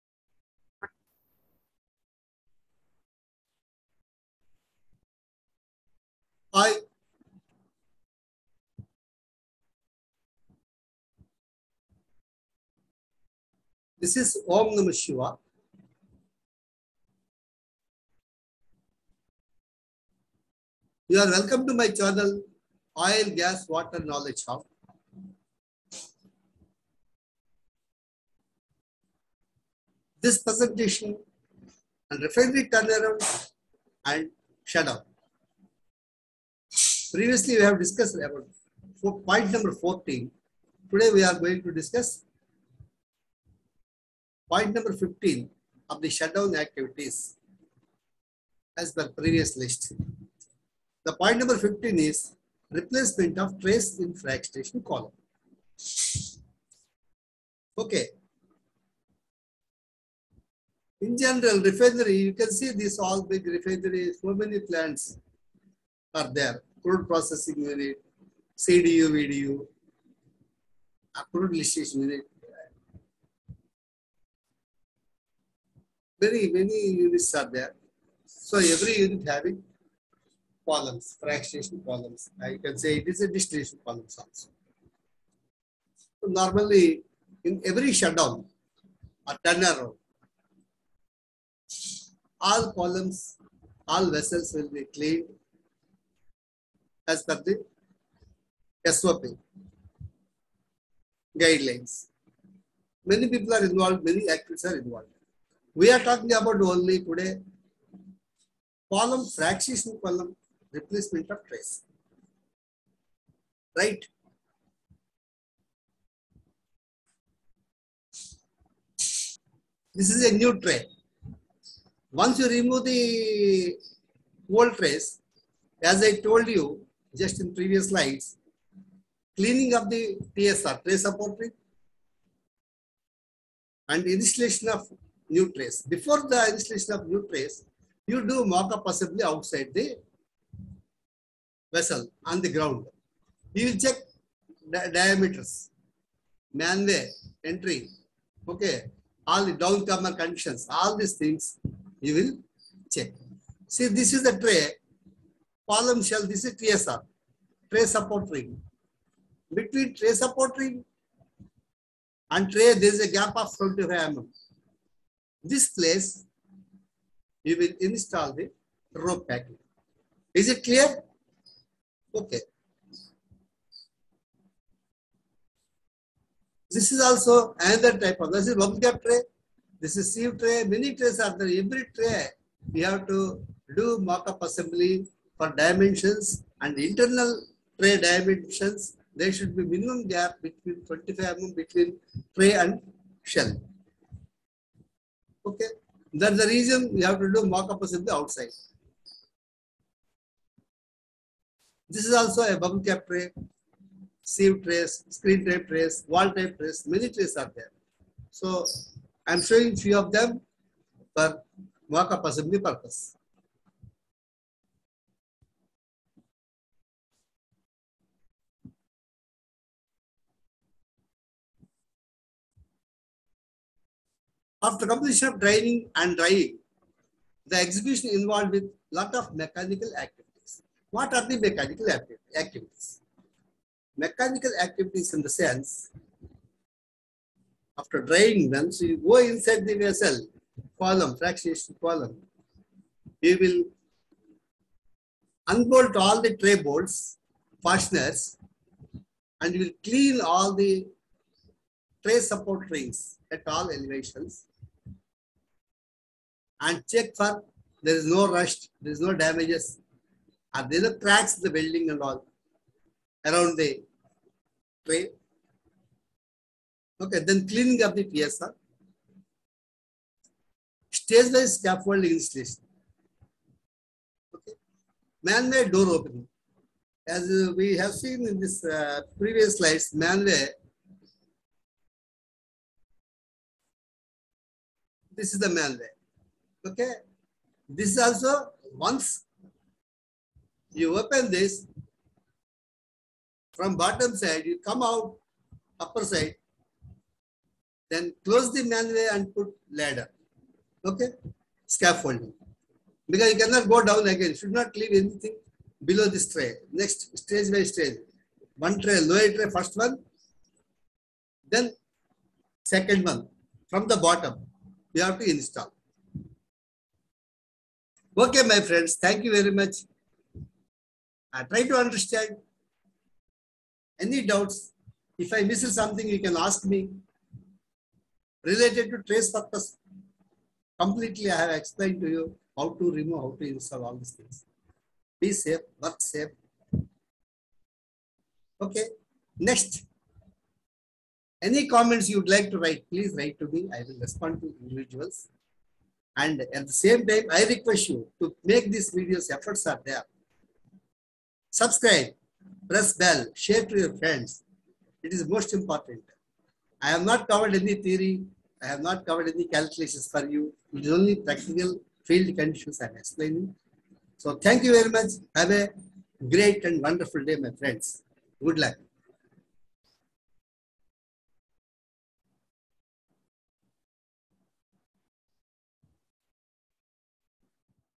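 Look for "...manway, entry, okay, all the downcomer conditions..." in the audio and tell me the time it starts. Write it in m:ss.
2:26.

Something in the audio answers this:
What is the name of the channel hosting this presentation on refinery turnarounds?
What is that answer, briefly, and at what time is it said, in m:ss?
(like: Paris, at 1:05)
Oil, Gas, Water Knowledge Hub, at 0:23.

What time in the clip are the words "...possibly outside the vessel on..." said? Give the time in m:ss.
2:18.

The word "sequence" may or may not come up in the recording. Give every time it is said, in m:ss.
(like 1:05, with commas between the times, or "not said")
not said.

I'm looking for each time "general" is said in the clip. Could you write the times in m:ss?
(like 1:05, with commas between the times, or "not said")
1:01.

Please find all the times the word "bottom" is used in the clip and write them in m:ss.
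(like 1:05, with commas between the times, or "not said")
4:53, 5:13.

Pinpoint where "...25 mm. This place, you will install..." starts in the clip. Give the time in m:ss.
2:43.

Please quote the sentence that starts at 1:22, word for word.
I can say it is a distillation columns also.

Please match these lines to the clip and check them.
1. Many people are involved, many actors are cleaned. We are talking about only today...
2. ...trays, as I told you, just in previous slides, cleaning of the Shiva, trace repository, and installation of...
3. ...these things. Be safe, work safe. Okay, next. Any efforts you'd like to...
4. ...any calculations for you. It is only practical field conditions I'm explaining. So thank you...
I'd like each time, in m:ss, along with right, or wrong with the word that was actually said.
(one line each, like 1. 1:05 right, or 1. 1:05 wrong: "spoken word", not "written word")
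1. 1:43 wrong: "involved", not "cleaned"
2. 2:04 wrong: "TSR", not "Shiva"
3. 5:33 wrong: "comments", not "efforts"
4. 5:59 right.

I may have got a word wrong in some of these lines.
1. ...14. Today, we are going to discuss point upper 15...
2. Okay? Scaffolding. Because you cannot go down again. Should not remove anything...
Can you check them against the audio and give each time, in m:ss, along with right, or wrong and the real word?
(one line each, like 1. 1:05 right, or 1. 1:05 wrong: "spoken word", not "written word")
1. 0:39 wrong: "number", not "upper"
2. 5:00 wrong: "leave", not "remove".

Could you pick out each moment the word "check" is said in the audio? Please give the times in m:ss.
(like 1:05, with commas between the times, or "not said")
2:23, 2:32, 4:16.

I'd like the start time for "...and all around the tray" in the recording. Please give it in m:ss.
4:21.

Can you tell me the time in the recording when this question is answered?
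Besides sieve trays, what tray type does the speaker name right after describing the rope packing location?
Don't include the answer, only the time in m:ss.
2:58.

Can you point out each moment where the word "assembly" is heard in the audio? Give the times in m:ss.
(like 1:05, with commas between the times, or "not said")
3:04, 3:17, 3:32.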